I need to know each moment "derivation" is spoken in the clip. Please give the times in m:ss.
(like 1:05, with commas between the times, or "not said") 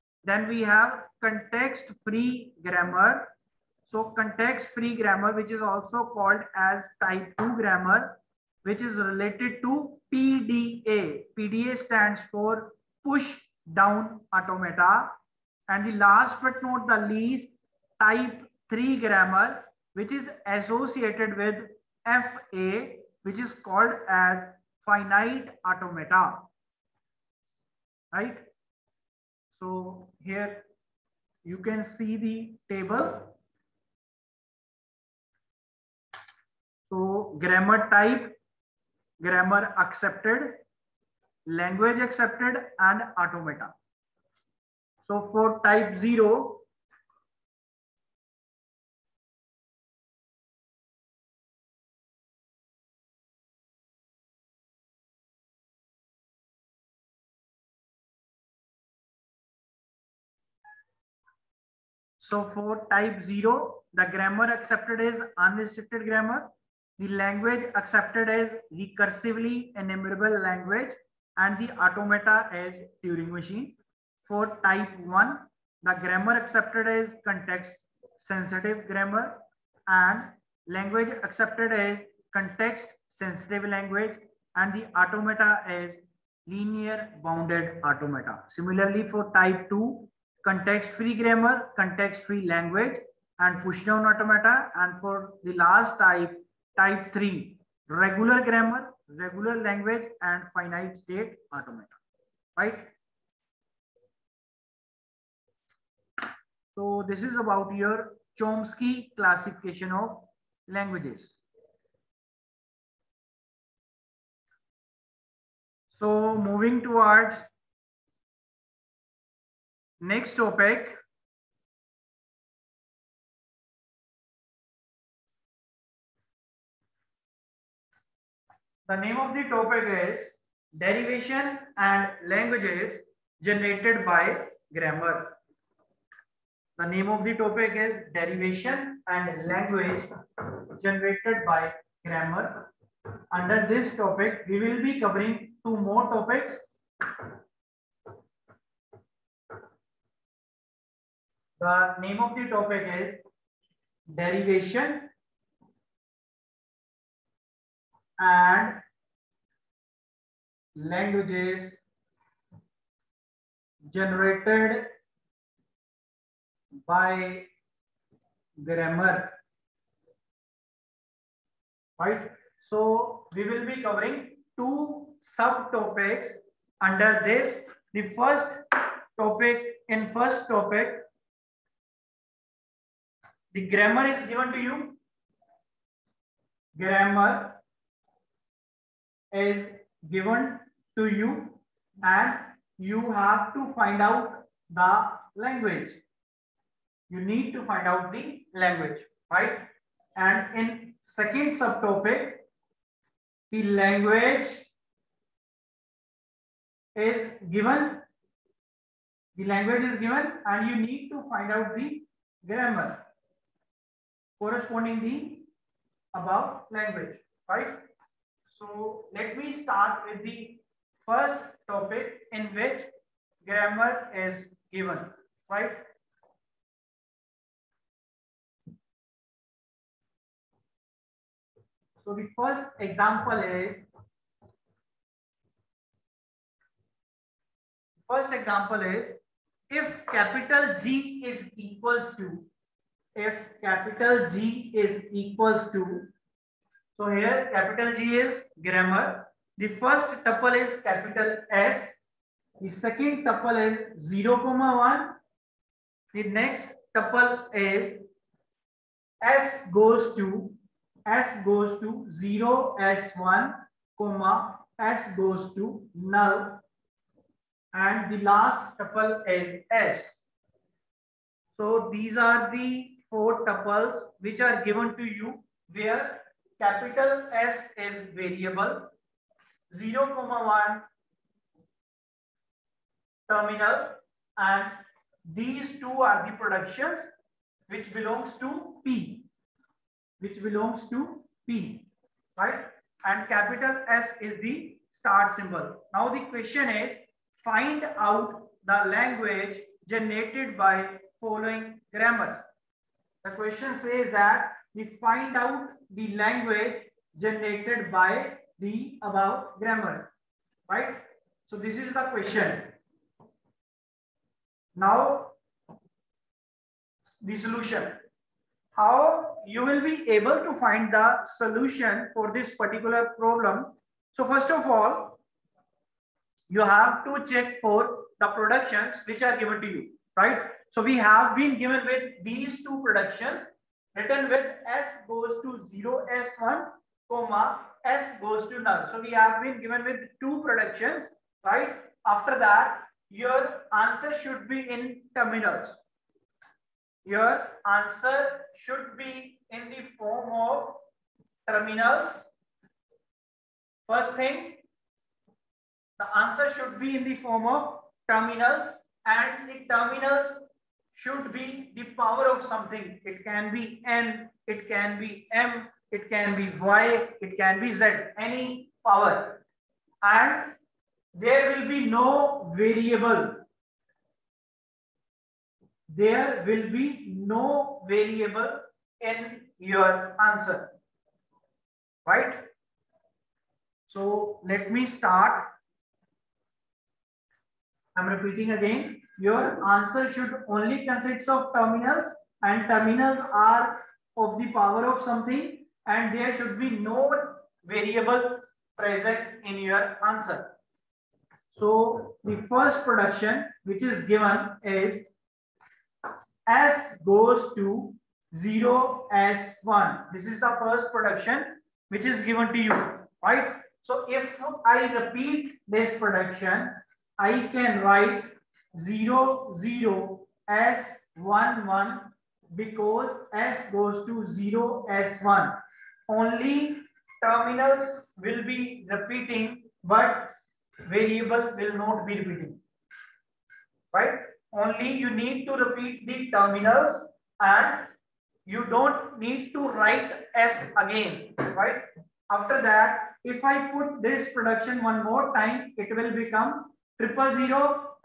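2:10, 2:18, 2:34.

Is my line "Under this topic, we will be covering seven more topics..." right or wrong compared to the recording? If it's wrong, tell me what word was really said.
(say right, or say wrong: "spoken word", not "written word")
wrong: "two", not "seven".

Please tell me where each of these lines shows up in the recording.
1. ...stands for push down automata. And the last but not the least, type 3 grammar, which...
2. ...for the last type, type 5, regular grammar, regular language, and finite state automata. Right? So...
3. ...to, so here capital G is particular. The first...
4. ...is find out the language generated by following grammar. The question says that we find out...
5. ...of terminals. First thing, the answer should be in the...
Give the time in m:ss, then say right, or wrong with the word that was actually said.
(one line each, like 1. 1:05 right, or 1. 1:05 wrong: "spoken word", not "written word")
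1. 0:11 right
2. 1:35 wrong: "3", not "5"
3. 4:05 wrong: "grammar", not "particular"
4. 4:56 right
5. 5:50 right.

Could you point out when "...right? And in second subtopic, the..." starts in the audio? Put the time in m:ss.
3:19.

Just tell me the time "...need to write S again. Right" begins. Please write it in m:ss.
7:19.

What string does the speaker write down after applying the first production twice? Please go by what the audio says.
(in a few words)
00S11.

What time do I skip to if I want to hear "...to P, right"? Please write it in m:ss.
4:50.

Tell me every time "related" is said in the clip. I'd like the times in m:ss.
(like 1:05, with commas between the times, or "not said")
0:08.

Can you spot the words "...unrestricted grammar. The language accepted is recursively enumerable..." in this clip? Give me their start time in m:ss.
1:05.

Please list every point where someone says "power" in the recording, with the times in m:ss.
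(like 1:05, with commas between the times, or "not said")
6:01, 6:08, 6:34.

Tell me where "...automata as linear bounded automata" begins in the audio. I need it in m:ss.
1:24.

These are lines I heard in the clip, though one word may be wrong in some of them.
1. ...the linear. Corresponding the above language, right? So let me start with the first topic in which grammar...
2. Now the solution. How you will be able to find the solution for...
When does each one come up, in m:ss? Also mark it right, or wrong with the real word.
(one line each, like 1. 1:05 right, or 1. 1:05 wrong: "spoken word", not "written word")
1. 3:31 wrong: "grammar", not "linear"
2. 5:14 right.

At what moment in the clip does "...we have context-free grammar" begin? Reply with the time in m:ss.
0:00.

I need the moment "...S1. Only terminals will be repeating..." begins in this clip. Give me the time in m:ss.
7:04.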